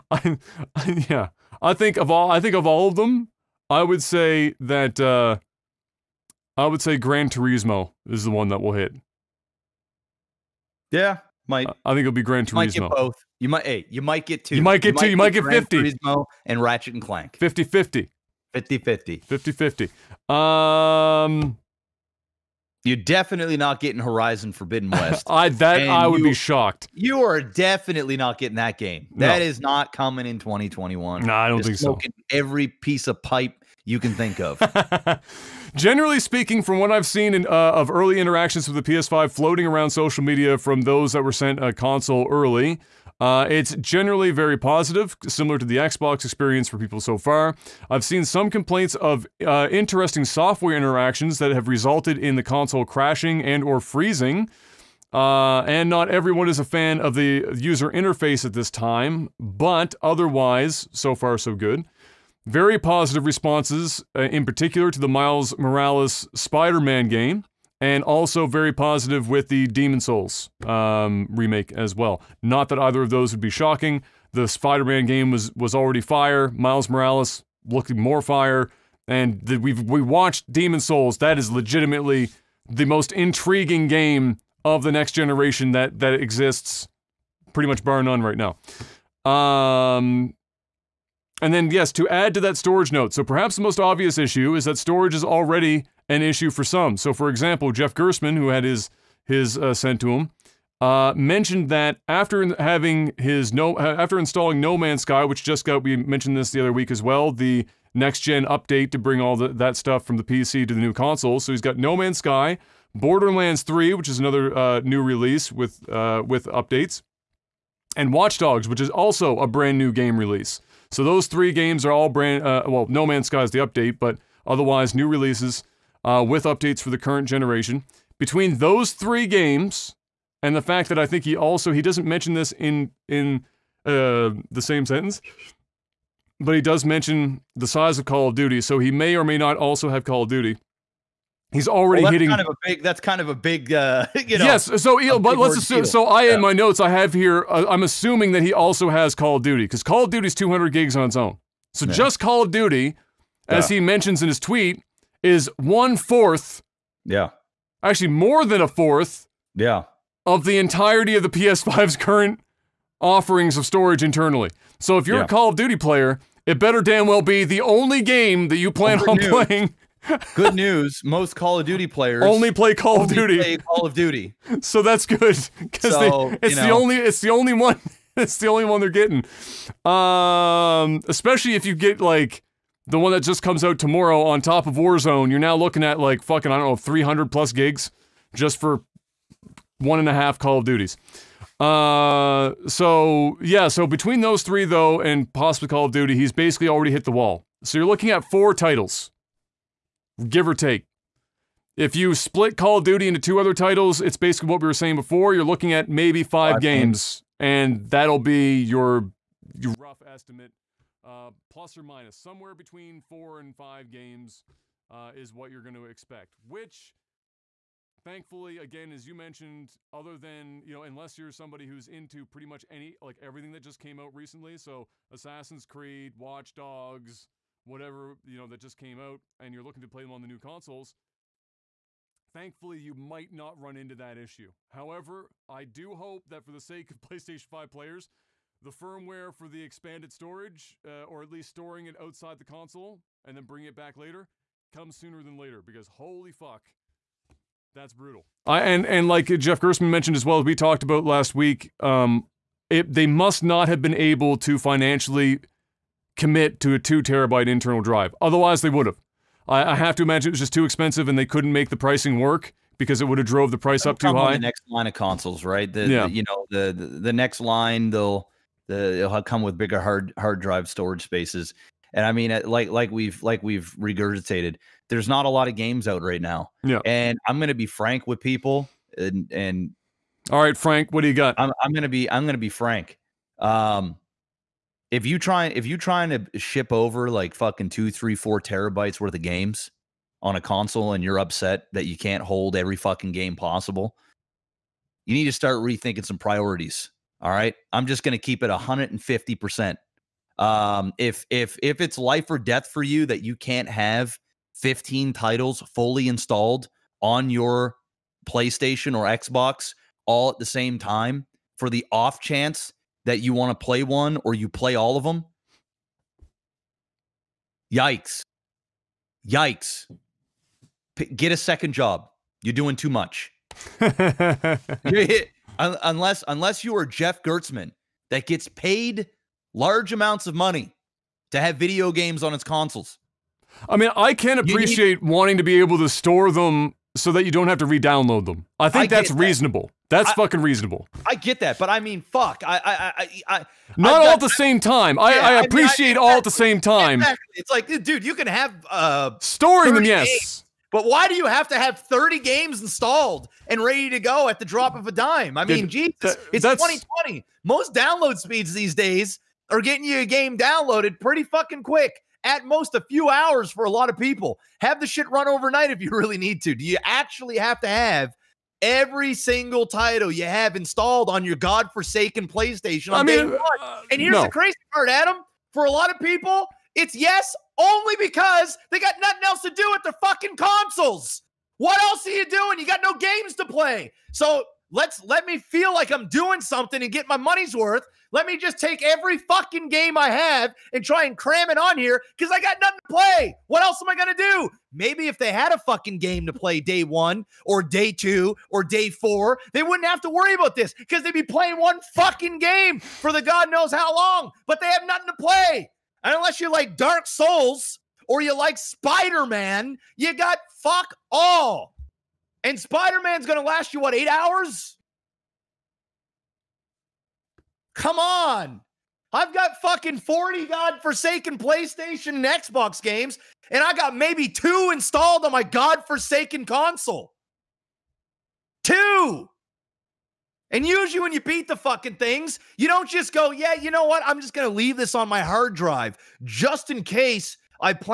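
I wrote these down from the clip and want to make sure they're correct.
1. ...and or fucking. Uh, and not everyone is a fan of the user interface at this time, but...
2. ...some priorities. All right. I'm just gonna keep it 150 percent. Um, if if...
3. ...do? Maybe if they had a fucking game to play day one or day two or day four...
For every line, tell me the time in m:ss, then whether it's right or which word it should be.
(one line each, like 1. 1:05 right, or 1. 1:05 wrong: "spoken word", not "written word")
1. 0:53 wrong: "freezing", not "fucking"
2. 4:56 right
3. 6:34 right.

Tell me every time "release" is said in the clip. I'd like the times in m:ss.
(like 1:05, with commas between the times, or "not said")
1:55, 2:00, 2:05.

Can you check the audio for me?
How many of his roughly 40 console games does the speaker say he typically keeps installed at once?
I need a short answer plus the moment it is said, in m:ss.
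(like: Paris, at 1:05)
2, at 7:03.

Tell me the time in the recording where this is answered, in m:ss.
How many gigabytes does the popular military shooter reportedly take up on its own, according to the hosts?
2:30.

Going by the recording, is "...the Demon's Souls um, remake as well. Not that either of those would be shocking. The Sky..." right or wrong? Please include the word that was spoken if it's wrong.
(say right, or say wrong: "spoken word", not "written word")
wrong: "Spider", not "Sky".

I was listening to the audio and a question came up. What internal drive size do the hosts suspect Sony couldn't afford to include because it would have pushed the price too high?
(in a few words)
2 terabytes.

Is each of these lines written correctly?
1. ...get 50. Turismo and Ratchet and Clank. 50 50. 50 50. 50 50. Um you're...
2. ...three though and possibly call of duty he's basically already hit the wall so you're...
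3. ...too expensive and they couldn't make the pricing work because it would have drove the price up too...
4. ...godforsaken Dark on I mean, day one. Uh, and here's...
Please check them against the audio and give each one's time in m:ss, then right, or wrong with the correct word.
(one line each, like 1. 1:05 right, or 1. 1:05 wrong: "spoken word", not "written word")
1. 0:15 right
2. 3:14 right
3. 4:20 right
4. 6:11 wrong: "PlayStation", not "Dark".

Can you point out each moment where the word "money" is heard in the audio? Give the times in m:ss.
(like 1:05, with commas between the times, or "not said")
5:30, 6:27.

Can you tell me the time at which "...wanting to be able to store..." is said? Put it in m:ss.
5:35.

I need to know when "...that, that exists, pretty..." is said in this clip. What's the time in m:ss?
1:25.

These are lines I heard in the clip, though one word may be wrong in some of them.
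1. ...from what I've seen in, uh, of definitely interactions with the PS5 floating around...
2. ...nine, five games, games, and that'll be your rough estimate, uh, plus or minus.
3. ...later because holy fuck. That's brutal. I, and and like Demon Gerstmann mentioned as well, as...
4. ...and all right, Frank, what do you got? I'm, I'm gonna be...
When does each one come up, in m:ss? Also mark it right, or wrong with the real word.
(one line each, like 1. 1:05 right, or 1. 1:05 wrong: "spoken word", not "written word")
1. 0:36 wrong: "early", not "definitely"
2. 3:26 wrong: "five", not "nine"
3. 4:05 wrong: "Jeff", not "Demon"
4. 4:39 right.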